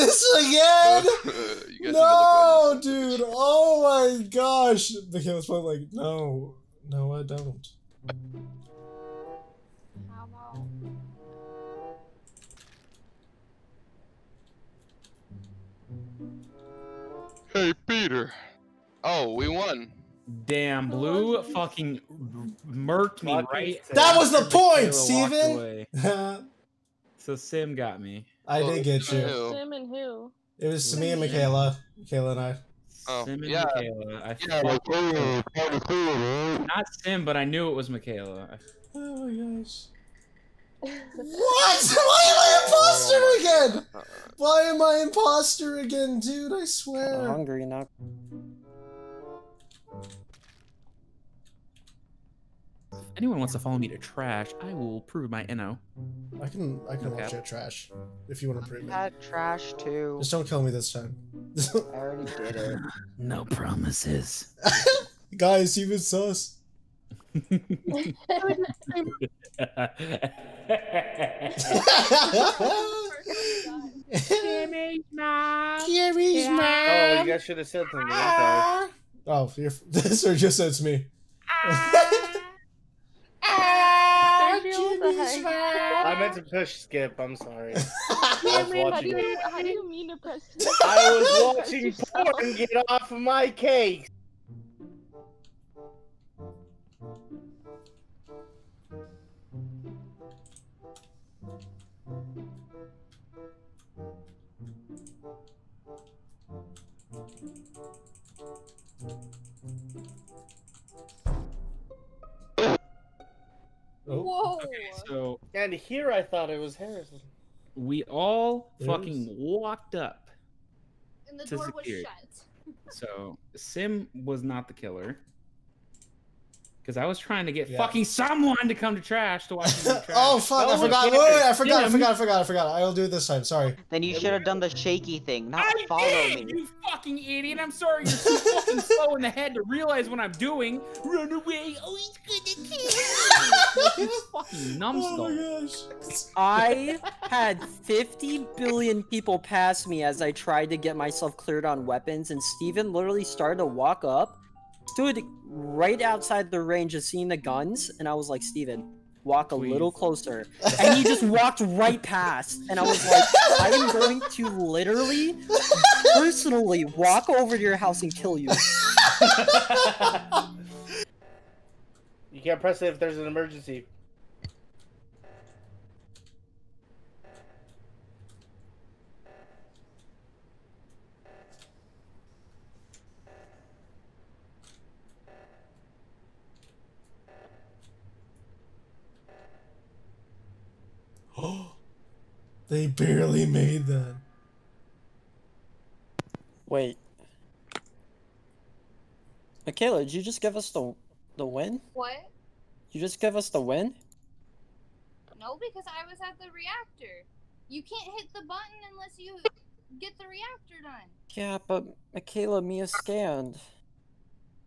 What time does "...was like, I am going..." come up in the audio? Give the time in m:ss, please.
2:42.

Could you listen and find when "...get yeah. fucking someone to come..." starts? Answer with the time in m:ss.
2:07.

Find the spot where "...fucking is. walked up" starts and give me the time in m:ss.
1:58.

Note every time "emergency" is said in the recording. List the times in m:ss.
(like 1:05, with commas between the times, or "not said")
2:53.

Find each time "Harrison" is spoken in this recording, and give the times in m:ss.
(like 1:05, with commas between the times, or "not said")
1:56.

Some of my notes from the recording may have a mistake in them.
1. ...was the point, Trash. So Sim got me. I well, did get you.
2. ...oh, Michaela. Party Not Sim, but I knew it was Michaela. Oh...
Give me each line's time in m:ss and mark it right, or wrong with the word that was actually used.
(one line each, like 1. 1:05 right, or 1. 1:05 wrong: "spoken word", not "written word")
1. 0:24 wrong: "Steven", not "Trash"
2. 0:34 right.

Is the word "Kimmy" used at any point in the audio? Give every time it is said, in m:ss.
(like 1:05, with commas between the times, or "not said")
1:07, 1:15.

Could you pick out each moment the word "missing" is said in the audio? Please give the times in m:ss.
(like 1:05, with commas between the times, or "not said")
not said.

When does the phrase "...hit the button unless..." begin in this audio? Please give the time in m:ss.
3:28.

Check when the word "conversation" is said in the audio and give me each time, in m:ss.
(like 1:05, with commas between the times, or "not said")
not said.